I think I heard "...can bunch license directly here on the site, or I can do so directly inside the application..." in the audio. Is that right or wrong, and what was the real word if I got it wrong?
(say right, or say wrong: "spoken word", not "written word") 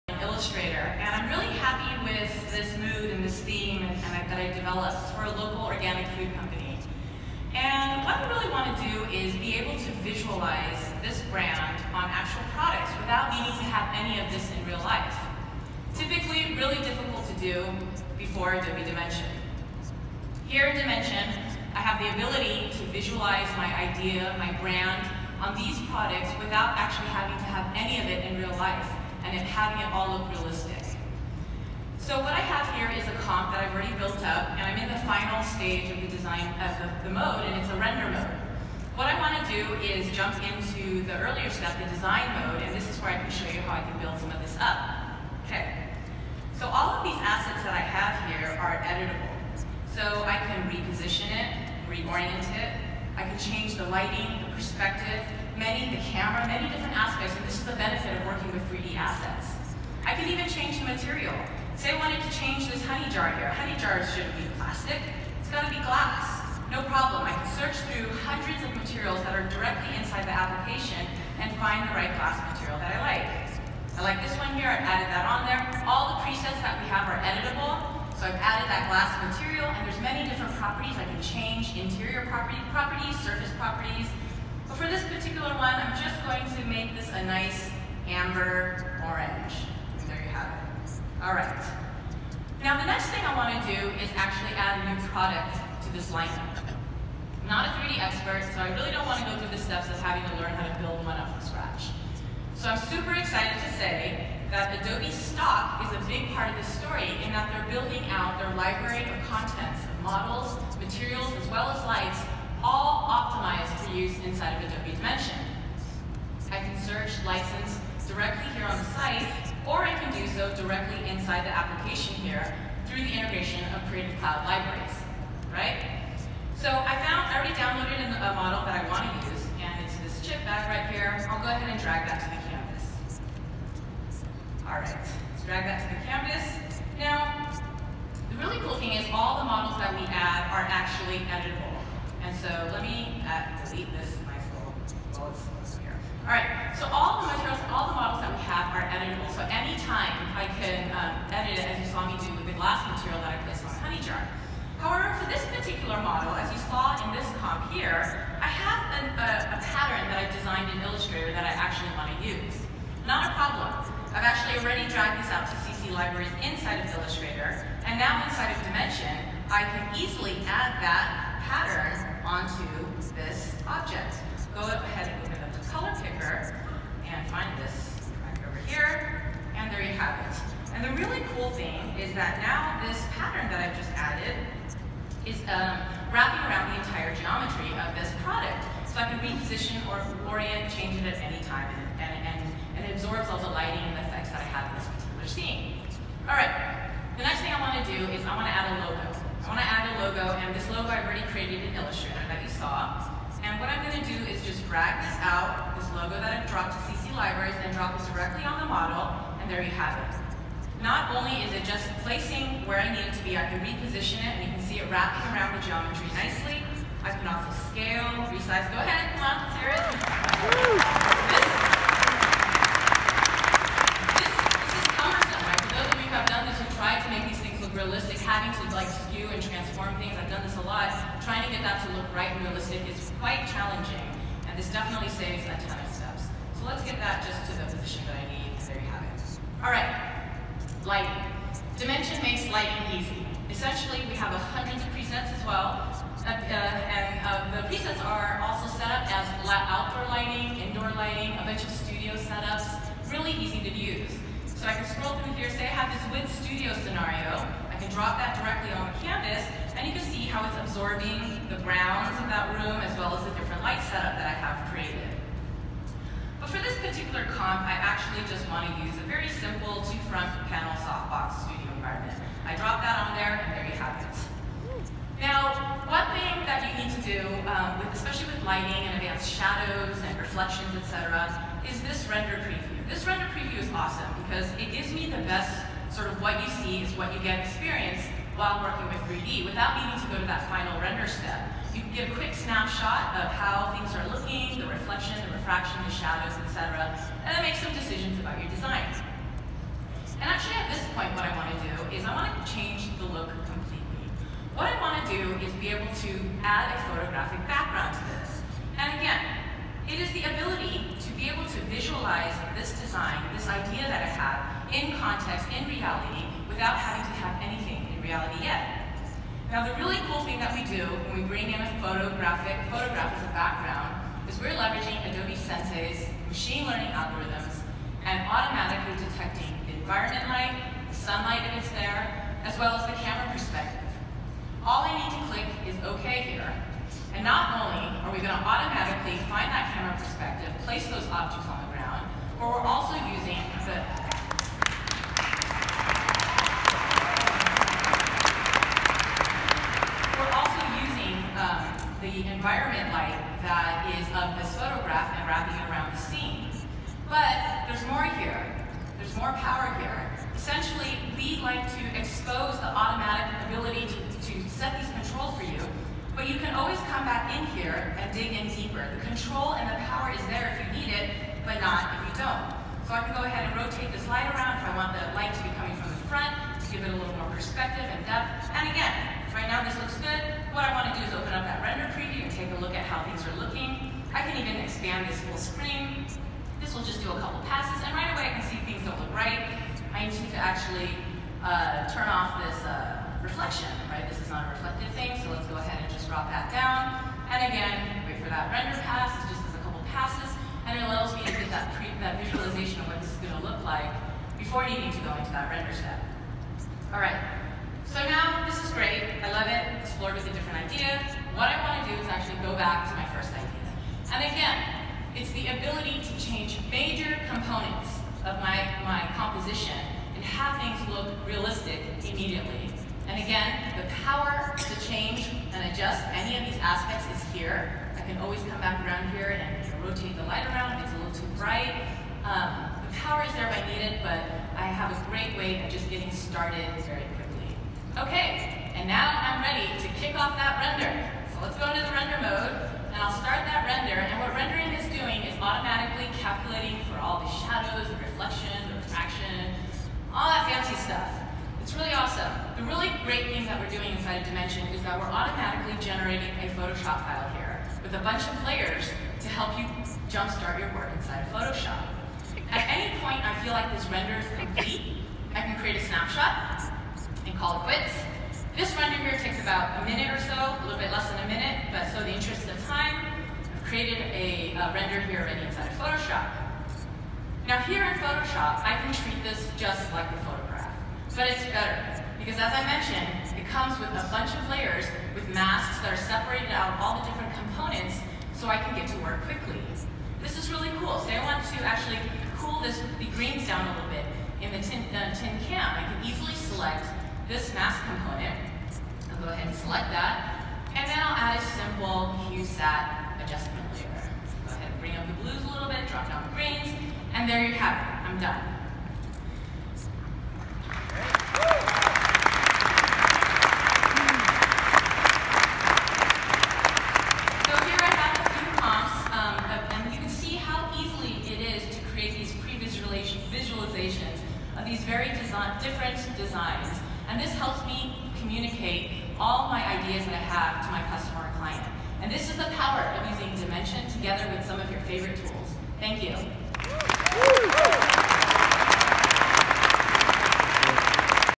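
wrong: "search", not "bunch".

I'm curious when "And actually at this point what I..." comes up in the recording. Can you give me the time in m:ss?
5:00.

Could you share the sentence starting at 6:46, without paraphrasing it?
All right, explored a different idea.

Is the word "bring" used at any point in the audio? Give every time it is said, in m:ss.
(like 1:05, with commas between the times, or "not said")
5:21, 8:24.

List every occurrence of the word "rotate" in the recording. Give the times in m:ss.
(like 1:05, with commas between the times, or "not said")
6:13, 7:09.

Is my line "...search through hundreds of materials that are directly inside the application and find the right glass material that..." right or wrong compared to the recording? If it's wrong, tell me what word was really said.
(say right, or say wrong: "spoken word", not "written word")
right.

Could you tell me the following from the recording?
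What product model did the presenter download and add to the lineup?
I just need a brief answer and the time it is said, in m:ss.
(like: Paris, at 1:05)
Chip bag, at 2:10.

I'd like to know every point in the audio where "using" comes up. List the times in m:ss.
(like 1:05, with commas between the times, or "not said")
5:43, 8:53.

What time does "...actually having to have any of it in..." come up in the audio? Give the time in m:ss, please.
0:26.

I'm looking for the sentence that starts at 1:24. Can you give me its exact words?
But for this particular one, I'm just going to make this a nice amber orange.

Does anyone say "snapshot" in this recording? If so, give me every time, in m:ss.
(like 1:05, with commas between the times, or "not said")
4:52, 7:45.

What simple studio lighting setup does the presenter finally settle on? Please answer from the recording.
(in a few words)
Two-front panel softbox.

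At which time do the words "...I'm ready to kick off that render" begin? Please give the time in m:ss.
7:19.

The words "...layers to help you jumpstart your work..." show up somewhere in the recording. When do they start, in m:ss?
7:38.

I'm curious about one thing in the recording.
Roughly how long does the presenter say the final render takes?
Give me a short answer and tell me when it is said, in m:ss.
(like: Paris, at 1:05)
About a minute, at 7:49.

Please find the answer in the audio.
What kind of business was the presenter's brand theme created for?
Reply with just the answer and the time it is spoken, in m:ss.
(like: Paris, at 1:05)
Local organic food company, at 0:05.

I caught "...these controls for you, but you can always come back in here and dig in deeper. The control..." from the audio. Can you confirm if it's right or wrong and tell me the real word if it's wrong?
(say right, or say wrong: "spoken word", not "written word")
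right.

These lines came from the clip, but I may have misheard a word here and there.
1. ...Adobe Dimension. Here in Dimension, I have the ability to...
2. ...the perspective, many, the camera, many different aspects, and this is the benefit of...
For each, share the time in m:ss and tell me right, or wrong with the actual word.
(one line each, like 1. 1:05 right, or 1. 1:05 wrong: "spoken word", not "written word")
1. 0:18 right
2. 0:54 right.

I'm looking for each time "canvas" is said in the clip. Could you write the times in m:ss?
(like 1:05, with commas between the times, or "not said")
2:16, 4:19.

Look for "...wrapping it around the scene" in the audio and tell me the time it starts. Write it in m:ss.
5:55.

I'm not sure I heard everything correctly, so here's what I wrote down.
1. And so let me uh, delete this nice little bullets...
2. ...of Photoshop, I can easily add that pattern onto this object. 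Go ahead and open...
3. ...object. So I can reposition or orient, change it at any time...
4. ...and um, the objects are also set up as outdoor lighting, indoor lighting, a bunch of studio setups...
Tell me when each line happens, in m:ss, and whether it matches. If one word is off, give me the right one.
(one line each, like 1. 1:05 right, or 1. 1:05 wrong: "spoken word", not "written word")
1. 2:22 right
2. 2:48 wrong: "Dimension", not "Photoshop"
3. 3:08 wrong: "product", not "object"
4. 4:06 wrong: "presets", not "objects".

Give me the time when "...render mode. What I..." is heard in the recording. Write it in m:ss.
0:37.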